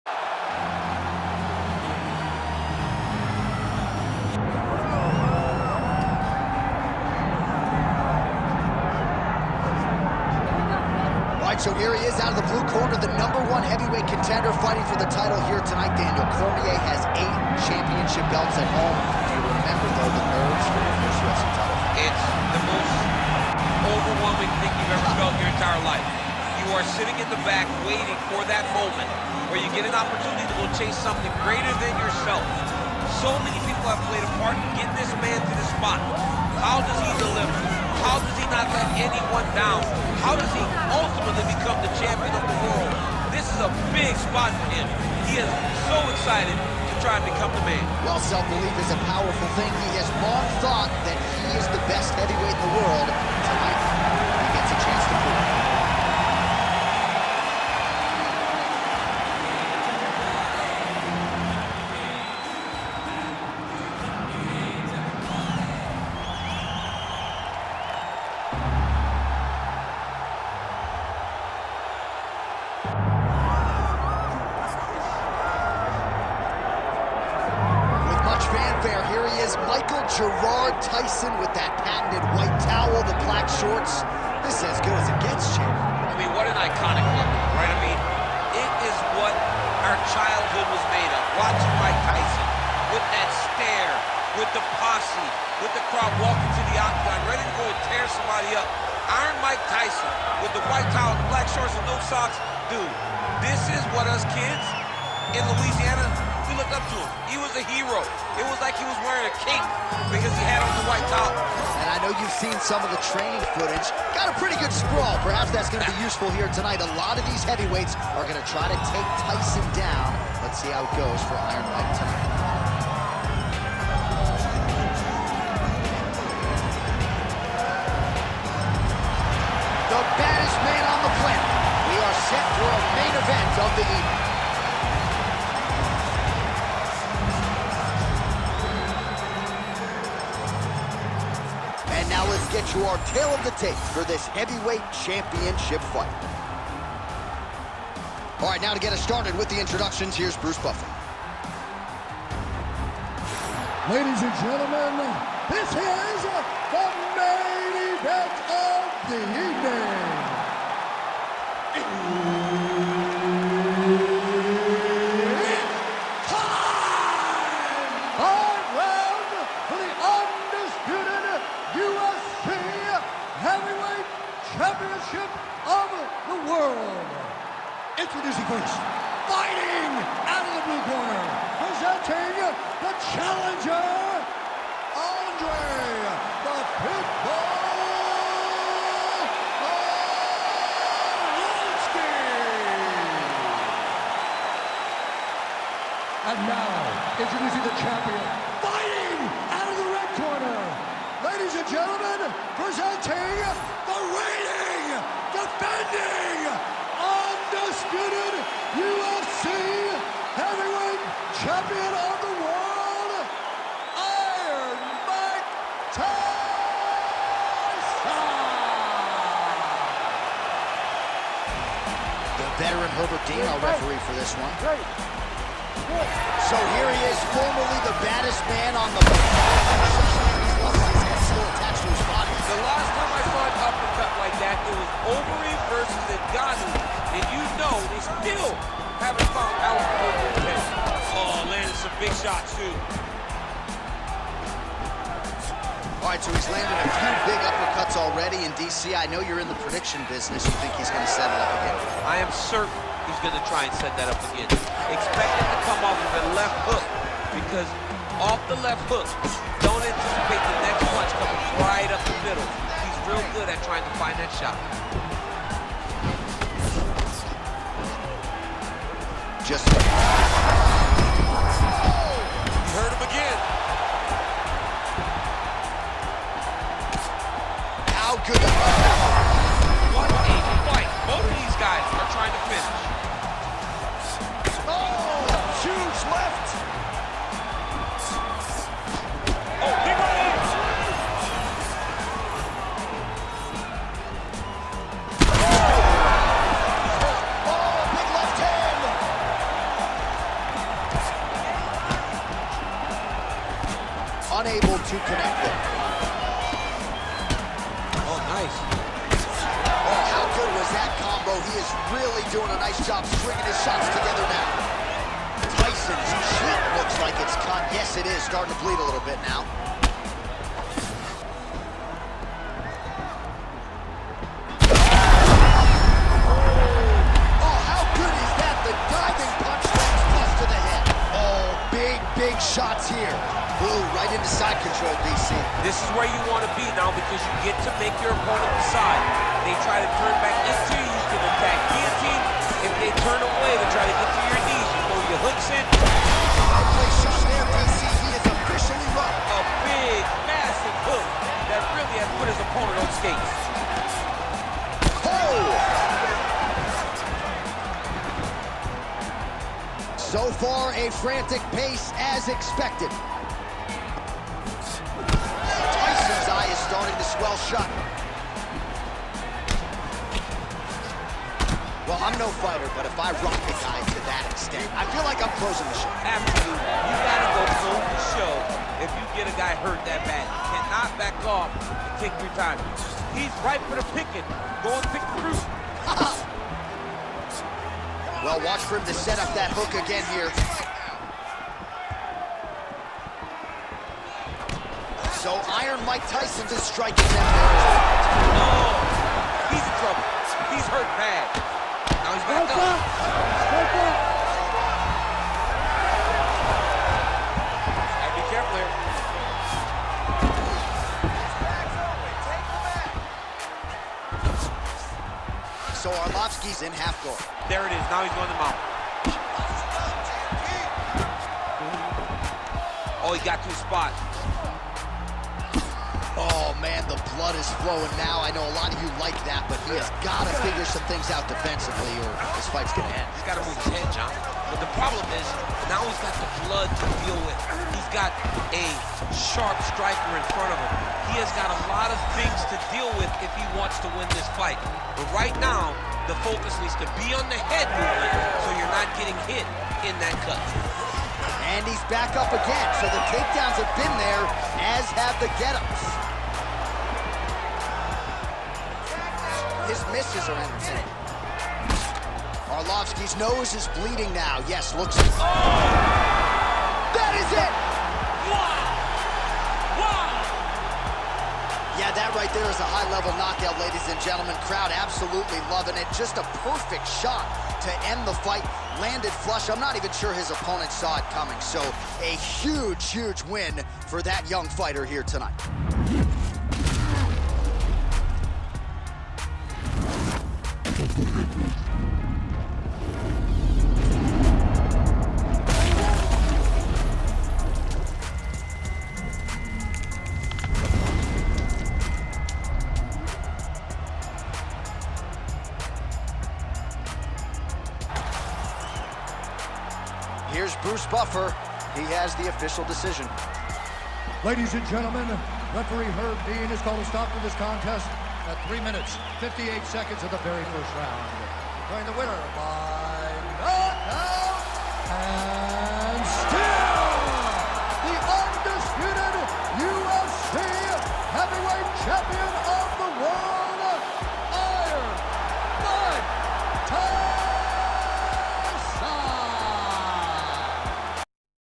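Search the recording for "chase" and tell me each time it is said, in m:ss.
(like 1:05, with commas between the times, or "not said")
0:30.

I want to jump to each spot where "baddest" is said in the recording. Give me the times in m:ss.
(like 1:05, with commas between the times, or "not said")
2:10, 3:48.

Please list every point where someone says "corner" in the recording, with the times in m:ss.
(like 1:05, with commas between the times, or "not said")
0:12, 3:00, 3:20.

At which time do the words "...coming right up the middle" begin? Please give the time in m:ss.
4:21.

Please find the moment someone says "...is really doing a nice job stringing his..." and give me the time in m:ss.
5:11.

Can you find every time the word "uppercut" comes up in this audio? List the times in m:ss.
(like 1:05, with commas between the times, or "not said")
3:53, 4:07.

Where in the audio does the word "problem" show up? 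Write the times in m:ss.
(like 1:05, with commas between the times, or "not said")
7:14.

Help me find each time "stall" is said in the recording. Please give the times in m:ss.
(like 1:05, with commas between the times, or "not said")
not said.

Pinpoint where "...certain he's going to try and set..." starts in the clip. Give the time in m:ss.
4:12.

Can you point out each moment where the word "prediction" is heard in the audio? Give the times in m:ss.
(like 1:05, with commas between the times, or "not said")
4:09.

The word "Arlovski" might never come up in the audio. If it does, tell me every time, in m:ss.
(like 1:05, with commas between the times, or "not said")
3:09, 6:56, 7:42.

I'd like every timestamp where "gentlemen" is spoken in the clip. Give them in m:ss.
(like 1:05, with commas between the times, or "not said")
2:34, 3:21, 7:54, 8:34.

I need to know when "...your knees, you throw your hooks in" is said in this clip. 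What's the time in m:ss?
5:44.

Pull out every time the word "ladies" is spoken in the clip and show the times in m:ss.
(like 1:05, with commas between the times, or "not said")
2:33, 3:21, 7:53, 8:34.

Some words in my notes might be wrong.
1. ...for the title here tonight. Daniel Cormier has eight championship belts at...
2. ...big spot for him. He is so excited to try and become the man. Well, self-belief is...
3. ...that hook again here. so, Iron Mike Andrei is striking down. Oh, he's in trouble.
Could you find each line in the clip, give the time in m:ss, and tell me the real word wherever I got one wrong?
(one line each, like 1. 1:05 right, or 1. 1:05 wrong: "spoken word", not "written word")
1. 0:14 right
2. 0:43 right
3. 6:29 wrong: "Tyson", not "Andrei".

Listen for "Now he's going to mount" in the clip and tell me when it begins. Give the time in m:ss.
6:57.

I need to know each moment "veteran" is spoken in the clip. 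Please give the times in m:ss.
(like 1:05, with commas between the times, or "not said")
3:42.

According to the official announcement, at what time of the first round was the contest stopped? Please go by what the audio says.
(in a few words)
3:58.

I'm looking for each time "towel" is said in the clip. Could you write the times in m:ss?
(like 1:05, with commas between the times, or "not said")
1:22, 1:40.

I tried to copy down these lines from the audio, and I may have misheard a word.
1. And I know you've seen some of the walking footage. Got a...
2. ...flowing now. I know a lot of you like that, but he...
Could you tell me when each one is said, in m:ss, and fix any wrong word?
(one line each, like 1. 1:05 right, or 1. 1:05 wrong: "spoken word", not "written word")
1. 1:51 wrong: "training", not "walking"
2. 7:07 right.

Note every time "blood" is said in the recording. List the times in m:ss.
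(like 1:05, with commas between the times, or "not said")
7:07, 7:16.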